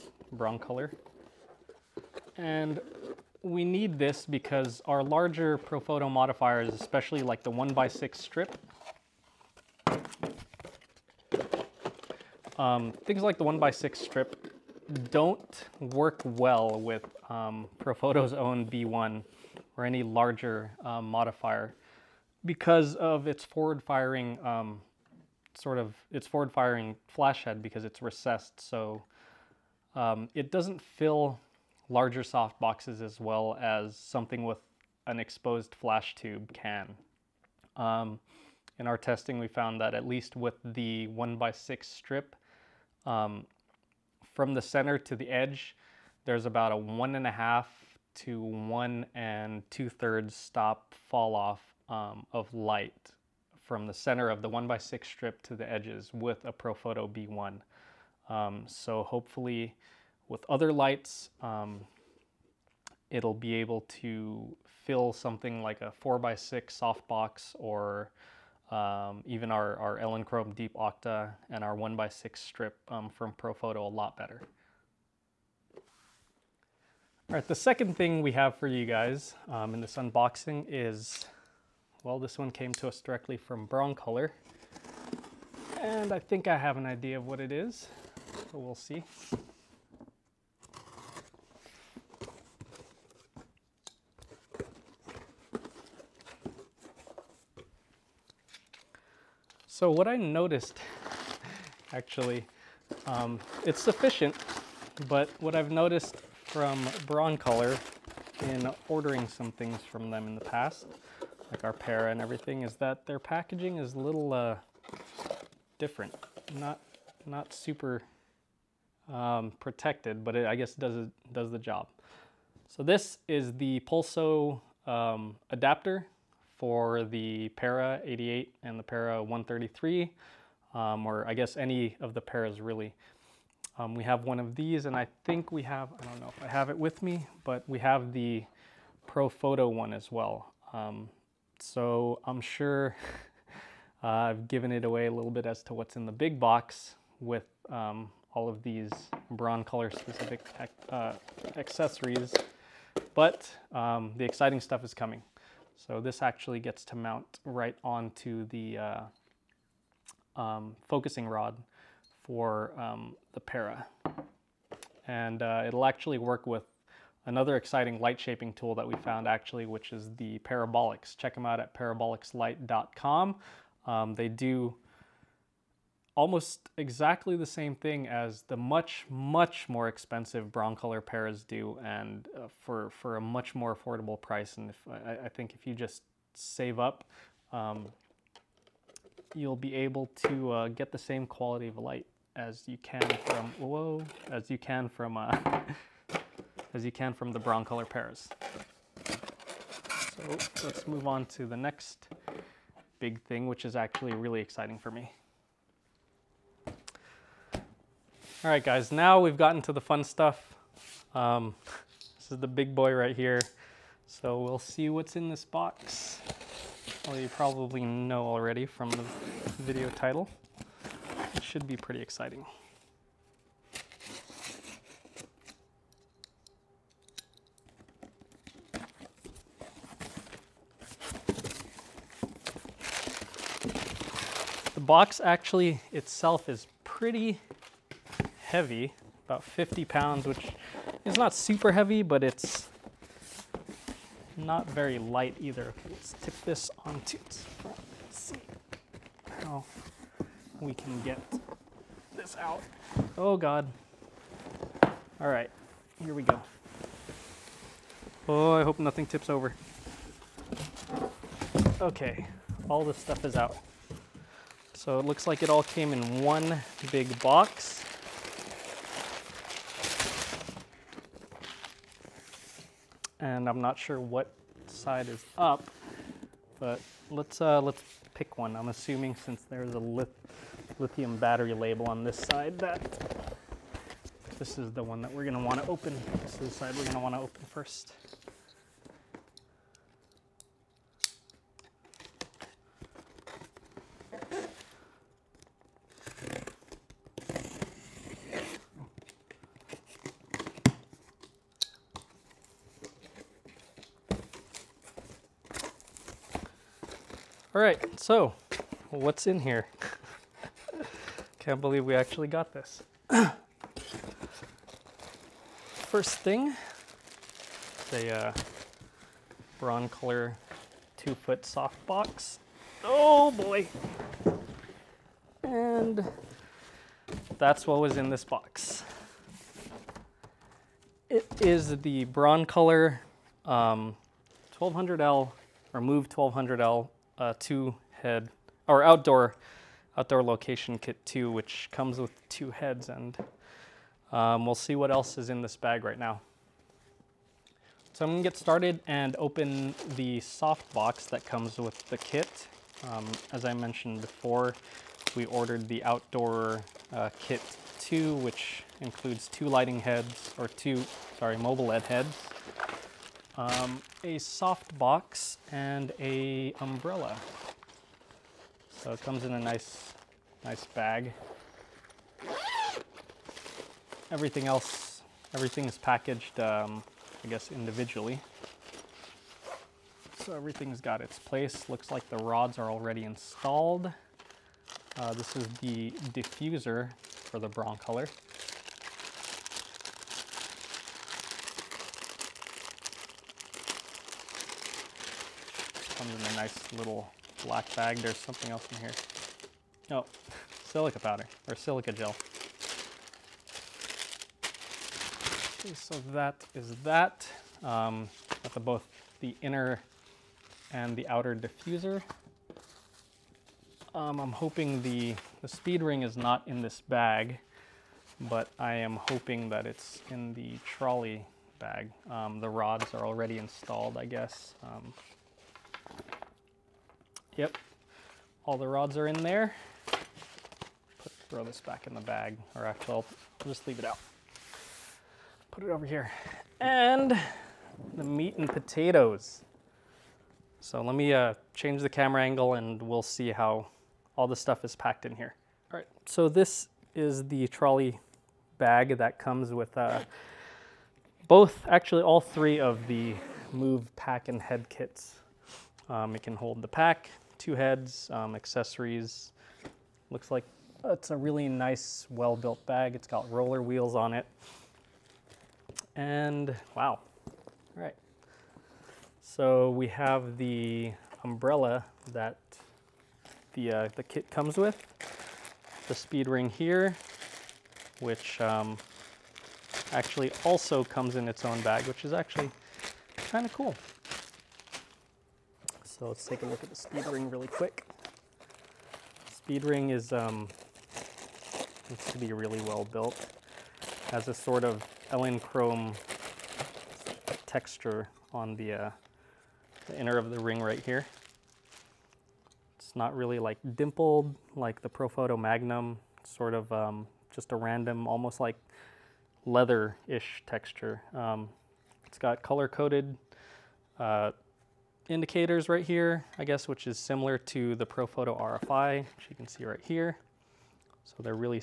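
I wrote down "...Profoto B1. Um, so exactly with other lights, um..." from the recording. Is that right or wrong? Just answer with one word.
wrong.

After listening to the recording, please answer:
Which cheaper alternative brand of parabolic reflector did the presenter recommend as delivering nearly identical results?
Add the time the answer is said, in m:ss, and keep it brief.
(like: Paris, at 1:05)
Parabolics, at 2:50.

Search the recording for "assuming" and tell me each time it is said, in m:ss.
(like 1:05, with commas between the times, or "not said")
4:38.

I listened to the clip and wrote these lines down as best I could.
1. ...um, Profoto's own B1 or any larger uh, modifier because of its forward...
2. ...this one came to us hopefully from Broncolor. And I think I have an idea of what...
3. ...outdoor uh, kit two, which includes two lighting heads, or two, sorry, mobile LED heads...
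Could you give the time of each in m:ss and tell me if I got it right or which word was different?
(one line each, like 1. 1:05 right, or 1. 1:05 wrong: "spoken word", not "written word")
1. 0:17 right
2. 1:22 wrong: "directly", not "hopefully"
3. 5:55 right.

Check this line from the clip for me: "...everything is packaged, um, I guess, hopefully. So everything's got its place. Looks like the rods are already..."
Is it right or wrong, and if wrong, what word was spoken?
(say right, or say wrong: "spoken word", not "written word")
wrong: "individually", not "hopefully".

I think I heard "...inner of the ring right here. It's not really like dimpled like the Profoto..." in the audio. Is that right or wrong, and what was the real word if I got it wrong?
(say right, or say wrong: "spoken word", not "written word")
right.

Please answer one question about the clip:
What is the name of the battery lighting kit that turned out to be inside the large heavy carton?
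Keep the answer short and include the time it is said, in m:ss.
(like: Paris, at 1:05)
Move 1200L, at 5:35.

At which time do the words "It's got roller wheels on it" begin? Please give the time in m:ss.
7:42.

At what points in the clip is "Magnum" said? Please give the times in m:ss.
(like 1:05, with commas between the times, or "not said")
8:25.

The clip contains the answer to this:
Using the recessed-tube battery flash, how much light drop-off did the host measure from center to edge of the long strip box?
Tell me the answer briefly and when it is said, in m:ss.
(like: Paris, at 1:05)
1.5 to 1.67 stops, at 0:46.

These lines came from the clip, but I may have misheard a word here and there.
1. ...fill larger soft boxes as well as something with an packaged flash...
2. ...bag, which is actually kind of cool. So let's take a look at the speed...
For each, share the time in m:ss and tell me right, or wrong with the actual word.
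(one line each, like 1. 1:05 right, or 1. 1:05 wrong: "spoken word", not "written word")
1. 0:30 wrong: "exposed", not "packaged"
2. 8:01 right.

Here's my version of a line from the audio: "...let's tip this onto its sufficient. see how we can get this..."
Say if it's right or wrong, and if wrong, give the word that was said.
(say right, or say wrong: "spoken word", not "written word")
wrong: "front", not "sufficient".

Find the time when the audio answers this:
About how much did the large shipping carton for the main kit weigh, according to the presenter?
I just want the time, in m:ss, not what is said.
3:59.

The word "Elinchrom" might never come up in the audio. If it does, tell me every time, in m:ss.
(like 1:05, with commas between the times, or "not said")
1:09, 8:15.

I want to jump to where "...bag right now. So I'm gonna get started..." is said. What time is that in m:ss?
5:45.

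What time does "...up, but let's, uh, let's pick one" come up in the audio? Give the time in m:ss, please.
4:35.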